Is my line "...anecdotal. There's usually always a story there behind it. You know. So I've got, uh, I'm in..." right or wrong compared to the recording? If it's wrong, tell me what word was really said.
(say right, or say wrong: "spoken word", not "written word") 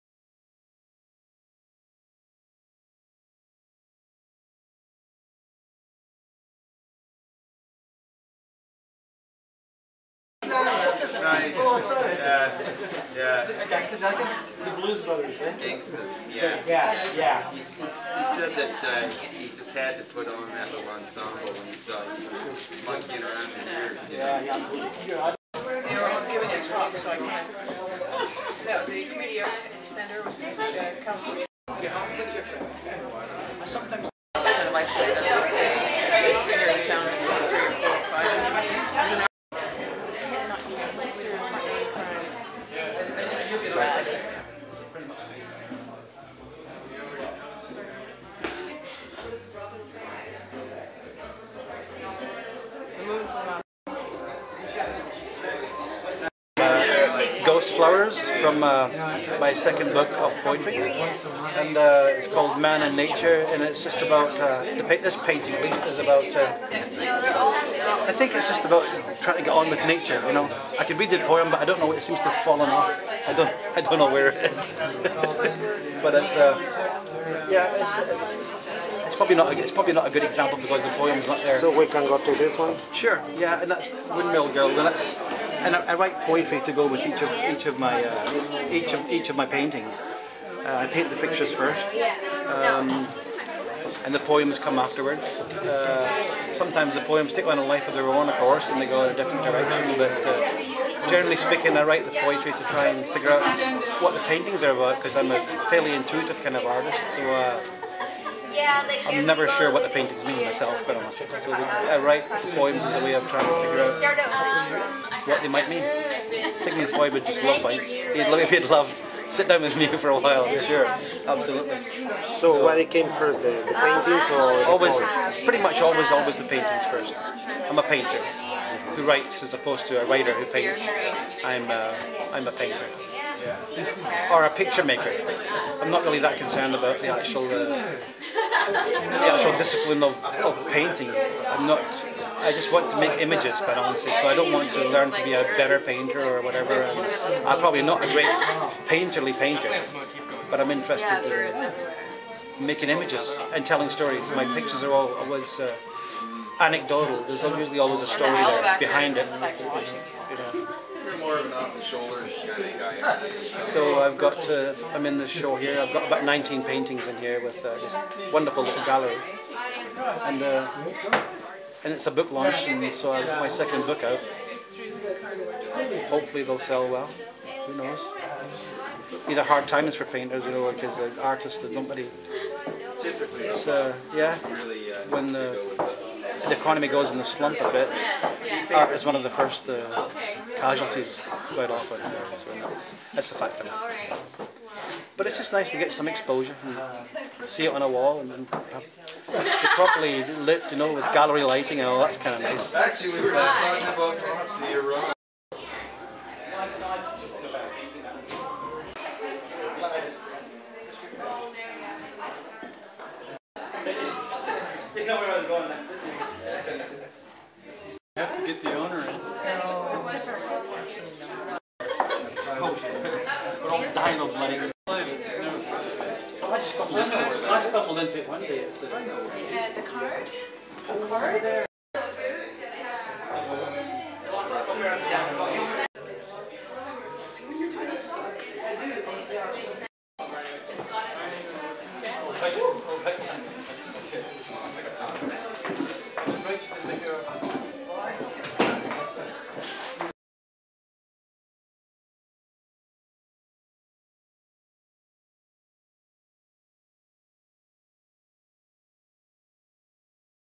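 right.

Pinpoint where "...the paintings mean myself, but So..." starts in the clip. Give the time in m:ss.
1:49.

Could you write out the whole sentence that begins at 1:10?
You know, I could read the poem, but I don't know.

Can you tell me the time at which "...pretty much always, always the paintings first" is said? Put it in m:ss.
2:05.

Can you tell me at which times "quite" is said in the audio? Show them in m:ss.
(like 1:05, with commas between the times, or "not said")
2:23, 3:11.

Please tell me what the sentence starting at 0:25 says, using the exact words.
They were all giving a talk, so I can't.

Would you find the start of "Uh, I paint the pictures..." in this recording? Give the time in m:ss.
1:30.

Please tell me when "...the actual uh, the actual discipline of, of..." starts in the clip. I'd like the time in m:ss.
2:17.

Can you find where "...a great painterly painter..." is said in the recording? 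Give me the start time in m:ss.
2:28.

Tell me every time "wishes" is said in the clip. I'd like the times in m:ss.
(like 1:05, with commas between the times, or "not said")
not said.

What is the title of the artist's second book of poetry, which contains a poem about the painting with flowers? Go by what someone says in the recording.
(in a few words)
Man and Nature.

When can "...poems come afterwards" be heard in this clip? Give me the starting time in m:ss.
1:34.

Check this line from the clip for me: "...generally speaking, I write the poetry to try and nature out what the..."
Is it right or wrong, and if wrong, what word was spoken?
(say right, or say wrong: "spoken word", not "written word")
wrong: "figure", not "nature".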